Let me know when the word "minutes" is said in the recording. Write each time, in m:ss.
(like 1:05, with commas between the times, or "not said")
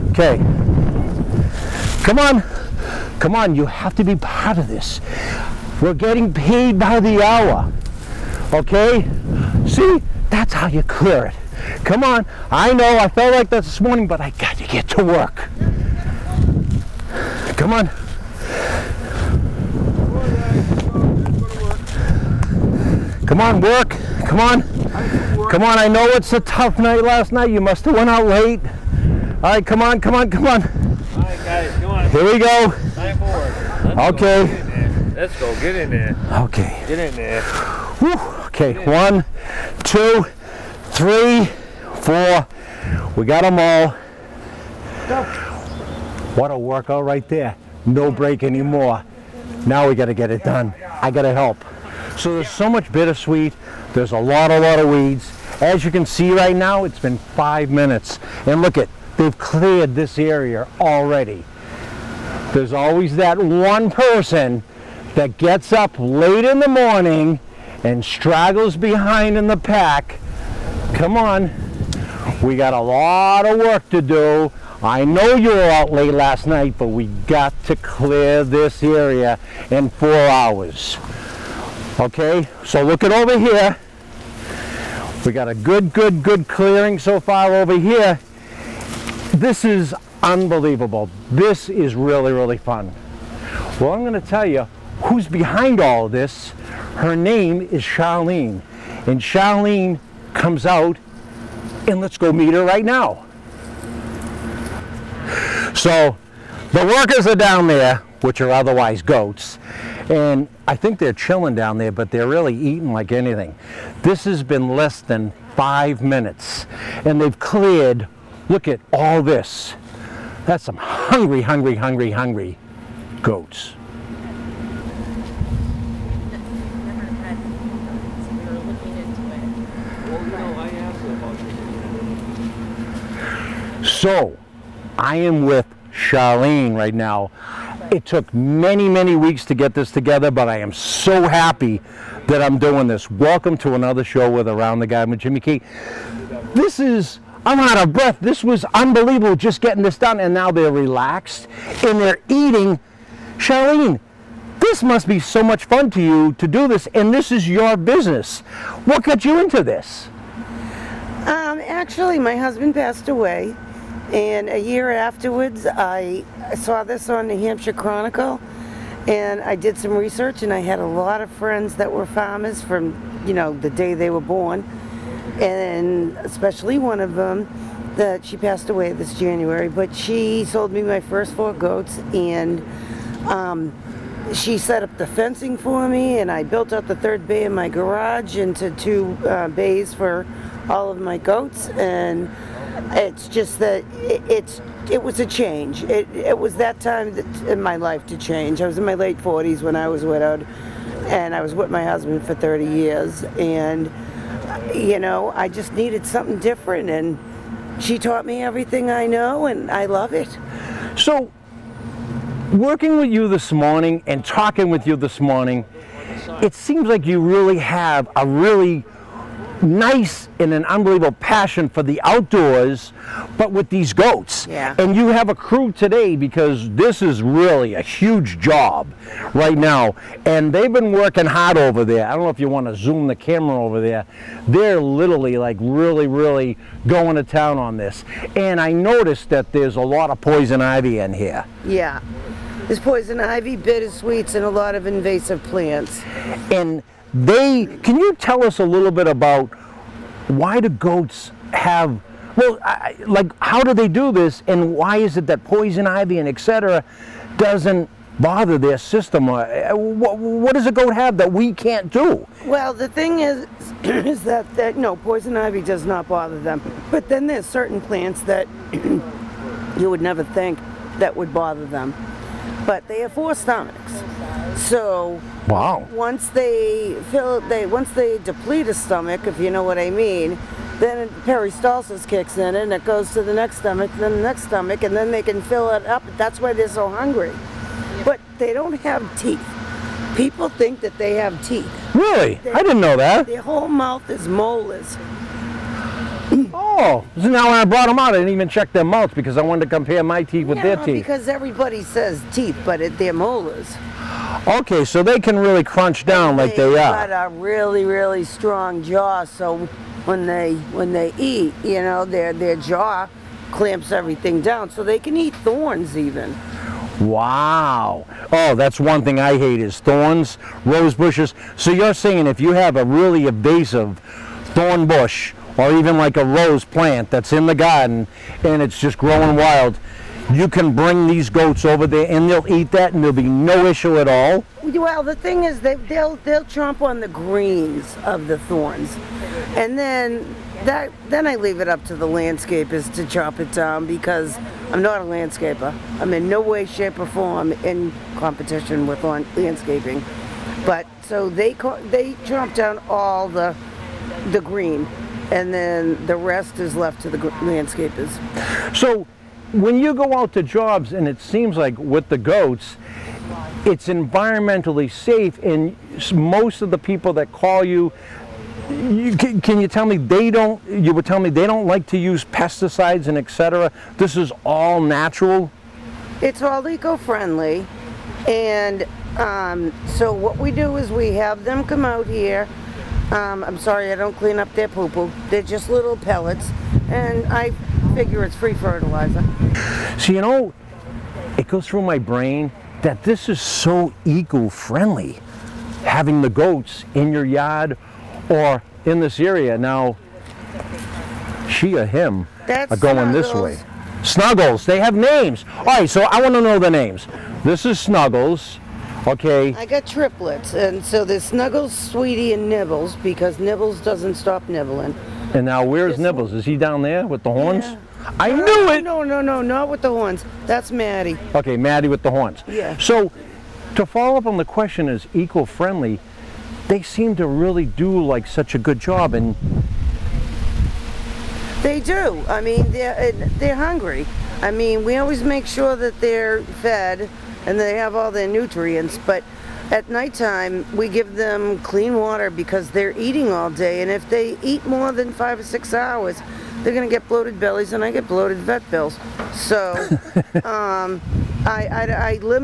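0:57, 1:56.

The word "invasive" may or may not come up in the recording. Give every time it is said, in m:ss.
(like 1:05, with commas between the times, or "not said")
4:04, 5:23.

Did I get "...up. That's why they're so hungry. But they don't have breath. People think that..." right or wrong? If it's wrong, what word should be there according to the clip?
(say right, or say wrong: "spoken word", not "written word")
wrong: "teeth", not "breath".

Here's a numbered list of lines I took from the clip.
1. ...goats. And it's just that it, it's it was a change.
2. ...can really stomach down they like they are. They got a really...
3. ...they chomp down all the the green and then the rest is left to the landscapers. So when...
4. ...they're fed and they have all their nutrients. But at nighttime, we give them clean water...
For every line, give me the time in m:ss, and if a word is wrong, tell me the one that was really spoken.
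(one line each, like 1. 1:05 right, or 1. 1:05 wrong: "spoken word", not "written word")
1. 3:11 right
2. 5:05 wrong: "crunch", not "stomach"
3. 5:51 right
4. 7:15 right.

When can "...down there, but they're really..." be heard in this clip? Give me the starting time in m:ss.
1:51.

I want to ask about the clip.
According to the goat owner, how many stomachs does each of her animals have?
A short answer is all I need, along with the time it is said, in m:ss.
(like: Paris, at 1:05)
4, at 4:33.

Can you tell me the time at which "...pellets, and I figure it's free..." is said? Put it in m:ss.
6:25.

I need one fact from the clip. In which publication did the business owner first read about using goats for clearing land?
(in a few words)
Hampshire Chronicle.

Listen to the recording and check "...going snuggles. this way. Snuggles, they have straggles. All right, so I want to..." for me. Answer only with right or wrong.
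wrong.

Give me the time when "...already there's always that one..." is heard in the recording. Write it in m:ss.
1:00.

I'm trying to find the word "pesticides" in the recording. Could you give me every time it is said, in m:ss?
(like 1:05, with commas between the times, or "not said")
6:12.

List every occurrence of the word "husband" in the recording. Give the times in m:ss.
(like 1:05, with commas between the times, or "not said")
2:42, 3:21.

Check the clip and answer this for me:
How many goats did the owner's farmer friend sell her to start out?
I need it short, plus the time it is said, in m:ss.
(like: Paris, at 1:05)
4, at 3:00.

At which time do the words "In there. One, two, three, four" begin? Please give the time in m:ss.
0:38.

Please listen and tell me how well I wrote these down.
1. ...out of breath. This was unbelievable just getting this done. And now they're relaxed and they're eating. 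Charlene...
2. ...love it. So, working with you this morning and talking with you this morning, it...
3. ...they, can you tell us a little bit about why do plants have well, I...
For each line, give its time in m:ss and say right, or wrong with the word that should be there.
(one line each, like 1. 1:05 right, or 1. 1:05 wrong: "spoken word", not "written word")
1. 2:27 right
2. 3:29 right
3. 4:07 wrong: "goats", not "plants".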